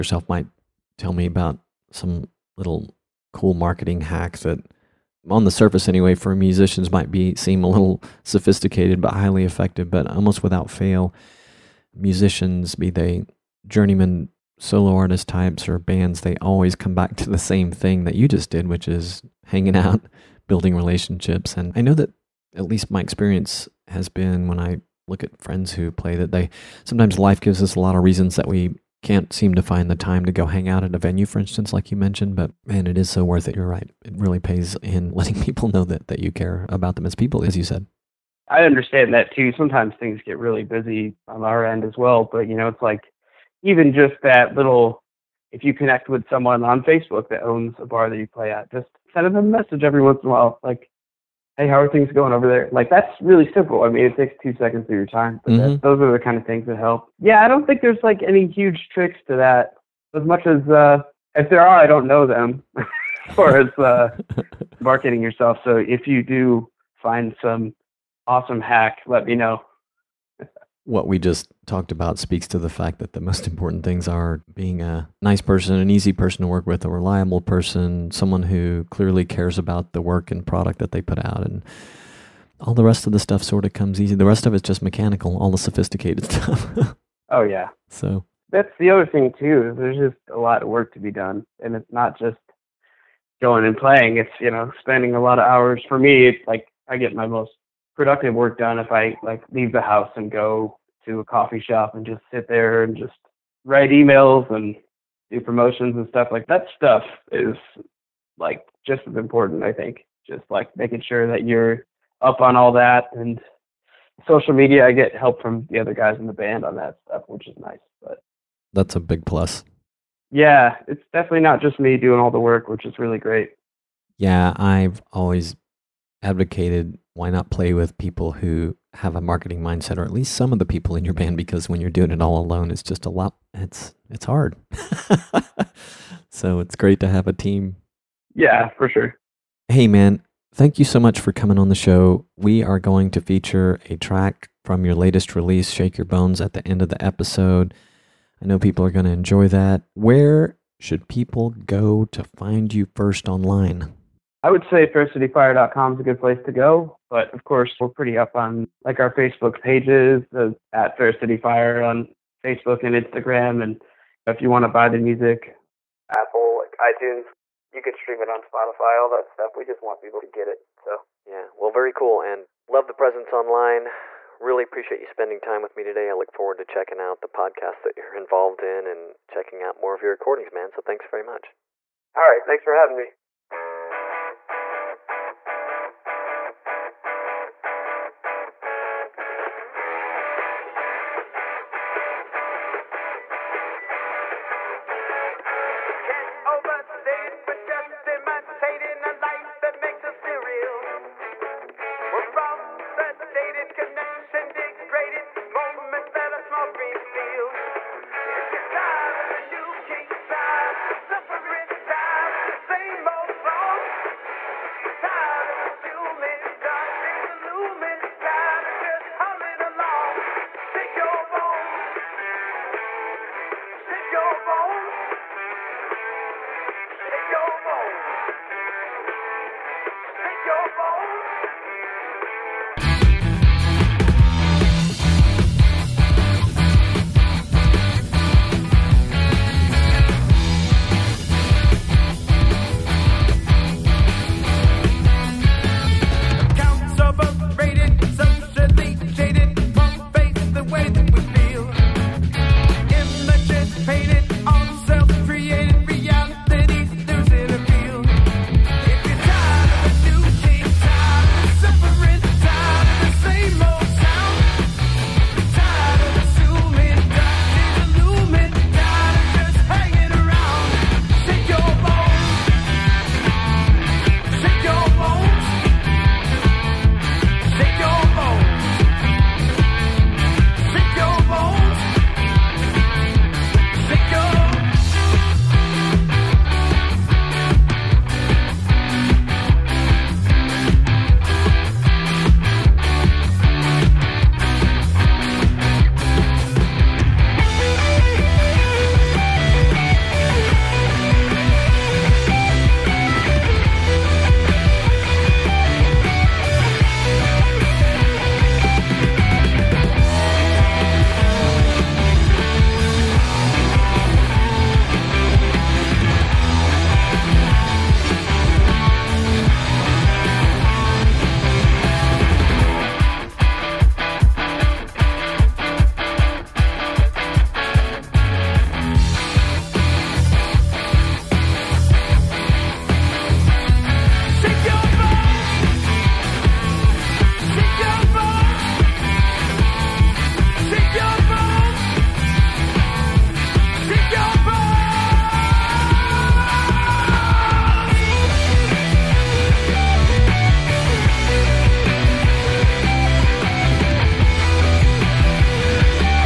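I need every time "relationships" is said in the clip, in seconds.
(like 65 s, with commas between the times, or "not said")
20 s.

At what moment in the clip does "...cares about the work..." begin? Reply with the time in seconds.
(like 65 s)
79 s.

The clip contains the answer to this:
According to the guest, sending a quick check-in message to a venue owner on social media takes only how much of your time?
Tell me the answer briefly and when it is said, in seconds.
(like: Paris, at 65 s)
2 seconds, at 54 s.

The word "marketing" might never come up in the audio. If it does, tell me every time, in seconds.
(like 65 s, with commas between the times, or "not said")
3 s, 64 s, 129 s.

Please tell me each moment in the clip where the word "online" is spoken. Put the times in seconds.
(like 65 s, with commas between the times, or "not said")
153 s, 173 s.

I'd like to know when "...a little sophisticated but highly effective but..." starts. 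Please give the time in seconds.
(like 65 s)
7 s.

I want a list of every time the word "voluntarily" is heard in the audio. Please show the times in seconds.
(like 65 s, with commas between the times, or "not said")
not said.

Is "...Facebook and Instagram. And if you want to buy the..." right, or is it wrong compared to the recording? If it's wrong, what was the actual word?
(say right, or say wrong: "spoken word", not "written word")
right.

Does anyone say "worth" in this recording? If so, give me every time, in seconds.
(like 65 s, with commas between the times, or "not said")
33 s.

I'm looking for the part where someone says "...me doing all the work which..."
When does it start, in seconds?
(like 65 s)
121 s.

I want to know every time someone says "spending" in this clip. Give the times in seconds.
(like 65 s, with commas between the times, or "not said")
94 s, 175 s.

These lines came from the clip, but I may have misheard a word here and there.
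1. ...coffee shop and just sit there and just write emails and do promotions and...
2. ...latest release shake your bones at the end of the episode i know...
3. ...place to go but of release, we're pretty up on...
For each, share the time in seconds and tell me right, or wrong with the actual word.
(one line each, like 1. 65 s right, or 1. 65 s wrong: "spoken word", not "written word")
1. 101 s right
2. 144 s right
3. 156 s wrong: "course", not "release".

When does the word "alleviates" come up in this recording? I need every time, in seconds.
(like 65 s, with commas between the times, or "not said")
not said.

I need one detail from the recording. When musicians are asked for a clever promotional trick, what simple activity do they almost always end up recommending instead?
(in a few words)
Hanging out.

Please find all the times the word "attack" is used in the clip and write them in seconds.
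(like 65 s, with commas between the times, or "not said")
not said.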